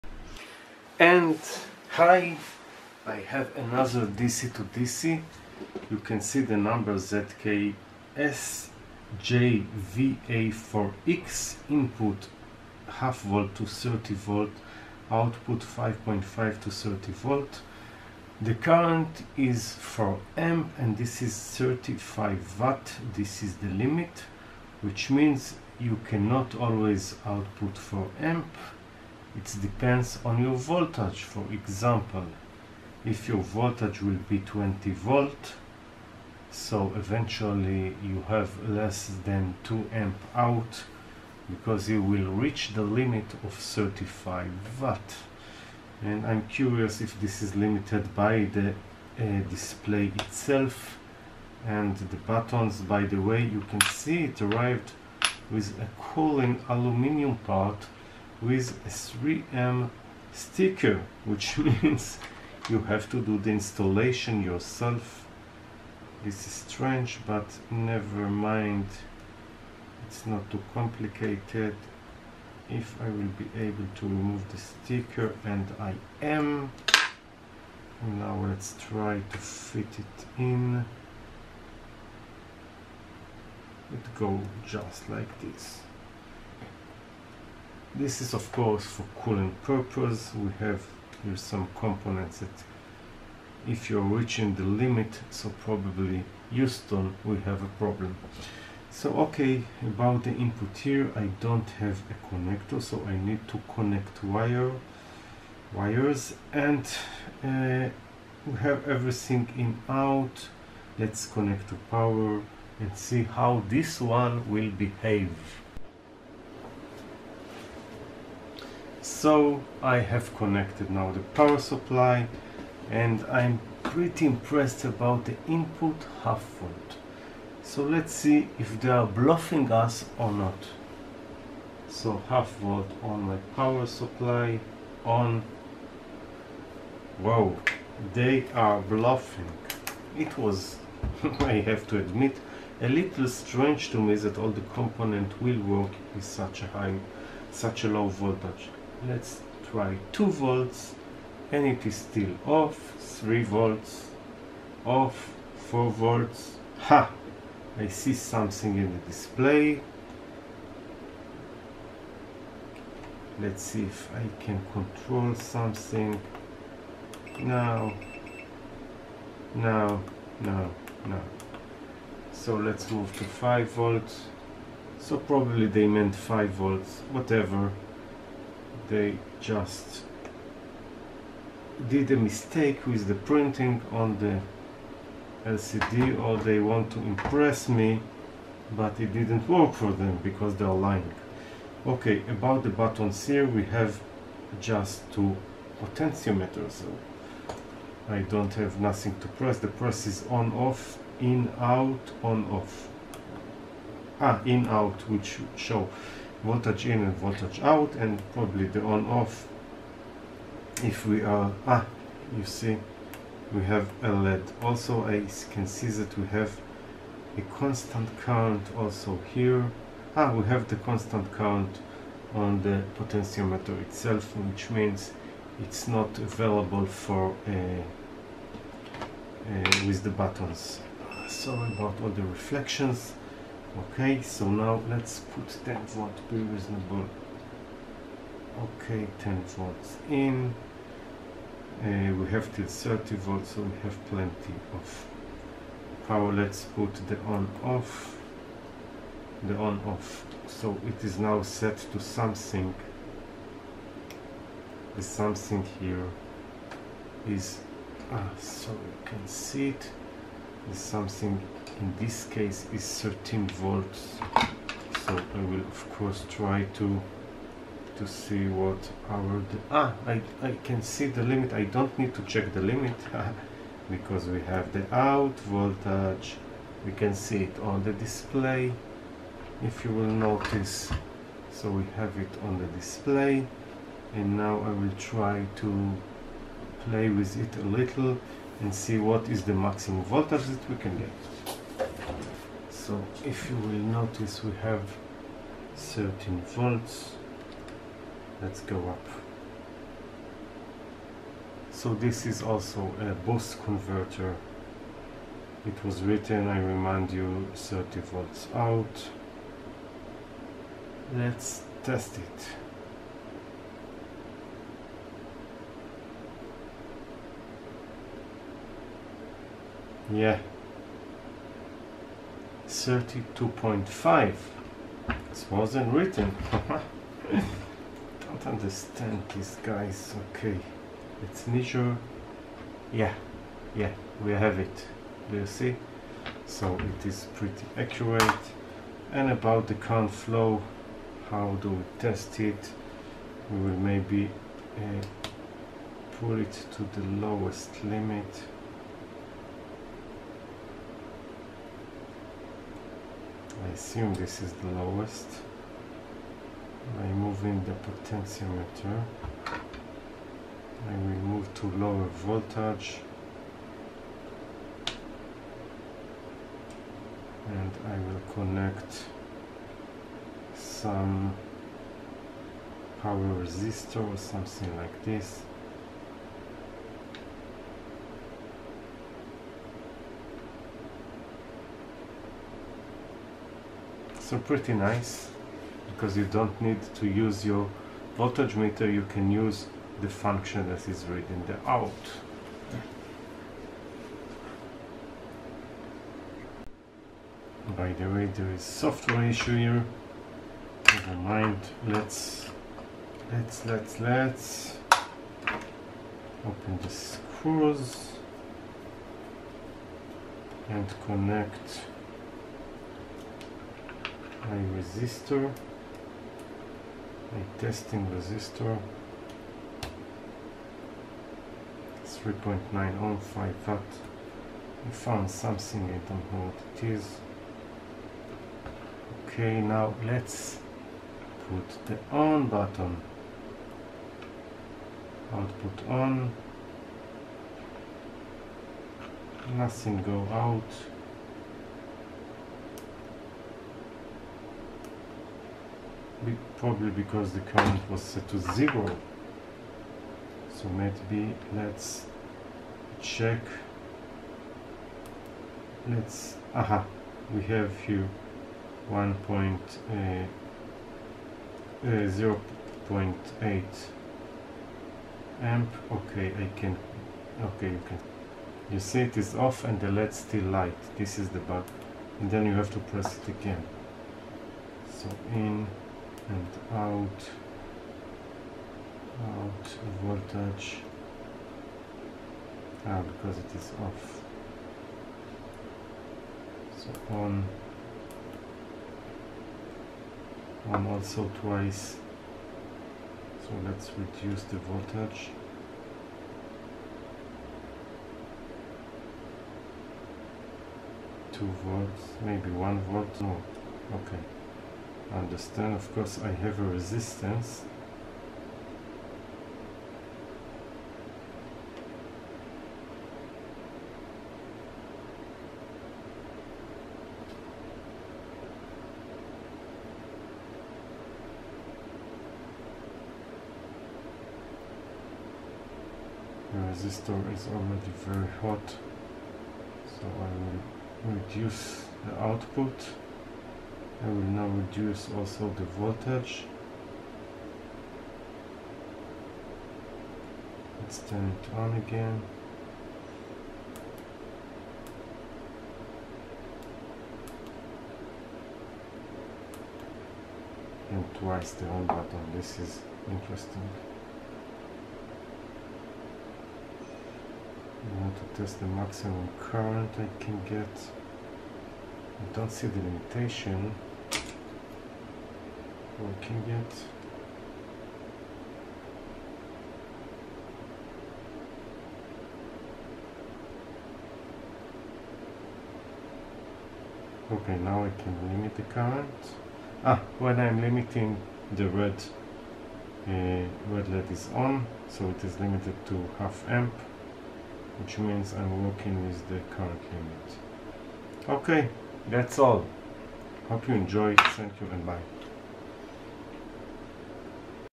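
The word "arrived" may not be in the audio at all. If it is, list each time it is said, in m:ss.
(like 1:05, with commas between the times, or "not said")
0:54.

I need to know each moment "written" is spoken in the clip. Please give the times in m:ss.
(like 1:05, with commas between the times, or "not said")
5:06, 5:25.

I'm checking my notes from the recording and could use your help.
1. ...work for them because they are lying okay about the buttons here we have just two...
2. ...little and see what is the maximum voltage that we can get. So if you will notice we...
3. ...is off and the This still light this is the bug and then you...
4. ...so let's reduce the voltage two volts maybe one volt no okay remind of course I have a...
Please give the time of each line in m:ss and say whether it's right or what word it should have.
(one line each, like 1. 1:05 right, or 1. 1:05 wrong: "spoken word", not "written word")
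1. 3:09 right
2. 4:47 right
3. 7:49 wrong: "LED", not "This"
4. 8:13 wrong: "understand", not "remind".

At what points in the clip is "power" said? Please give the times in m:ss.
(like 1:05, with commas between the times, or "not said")
1:51, 2:01, 2:13, 4:06, 6:13.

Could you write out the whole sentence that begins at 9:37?
Okay, now I can limit the current.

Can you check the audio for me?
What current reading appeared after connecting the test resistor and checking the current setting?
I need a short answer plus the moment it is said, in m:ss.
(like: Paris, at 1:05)
0.8 amp, at 7:42.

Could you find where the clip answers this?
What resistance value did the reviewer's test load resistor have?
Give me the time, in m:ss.
7:02.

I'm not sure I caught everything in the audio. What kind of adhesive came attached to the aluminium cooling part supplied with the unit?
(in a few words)
3M sticker.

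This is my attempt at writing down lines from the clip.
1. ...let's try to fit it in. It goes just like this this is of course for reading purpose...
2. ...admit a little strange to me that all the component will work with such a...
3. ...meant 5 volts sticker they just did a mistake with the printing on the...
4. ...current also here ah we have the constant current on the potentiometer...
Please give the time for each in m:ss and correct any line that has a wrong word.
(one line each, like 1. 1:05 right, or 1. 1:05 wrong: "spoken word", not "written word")
1. 1:18 wrong: "cooling", not "reading"
2. 2:21 right
3. 2:55 wrong: "whatever", not "sticker"
4. 3:38 right.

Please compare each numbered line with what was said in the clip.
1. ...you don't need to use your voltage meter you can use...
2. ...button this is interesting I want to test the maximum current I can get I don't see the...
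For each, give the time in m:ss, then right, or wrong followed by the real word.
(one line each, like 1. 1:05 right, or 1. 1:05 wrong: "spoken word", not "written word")
1. 6:26 right
2. 9:11 right.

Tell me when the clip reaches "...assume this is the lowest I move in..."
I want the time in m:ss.
5:53.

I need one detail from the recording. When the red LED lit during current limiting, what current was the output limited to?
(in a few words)
half amp.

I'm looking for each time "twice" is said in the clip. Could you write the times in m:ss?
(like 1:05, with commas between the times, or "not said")
8:11, 9:11.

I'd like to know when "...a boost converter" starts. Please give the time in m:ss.
5:02.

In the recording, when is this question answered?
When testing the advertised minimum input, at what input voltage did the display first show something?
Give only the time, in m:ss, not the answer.
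2:35.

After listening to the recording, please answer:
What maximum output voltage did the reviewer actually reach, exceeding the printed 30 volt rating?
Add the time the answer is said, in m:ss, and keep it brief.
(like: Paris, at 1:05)
32.5, at 5:22.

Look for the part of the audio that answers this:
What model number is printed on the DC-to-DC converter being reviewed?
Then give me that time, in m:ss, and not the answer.
0:06.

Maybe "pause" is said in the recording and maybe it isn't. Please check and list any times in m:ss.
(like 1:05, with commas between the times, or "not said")
not said.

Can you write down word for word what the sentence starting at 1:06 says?
This is strange, but never mind.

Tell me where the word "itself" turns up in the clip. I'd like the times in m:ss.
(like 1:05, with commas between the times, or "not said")
0:50, 3:43.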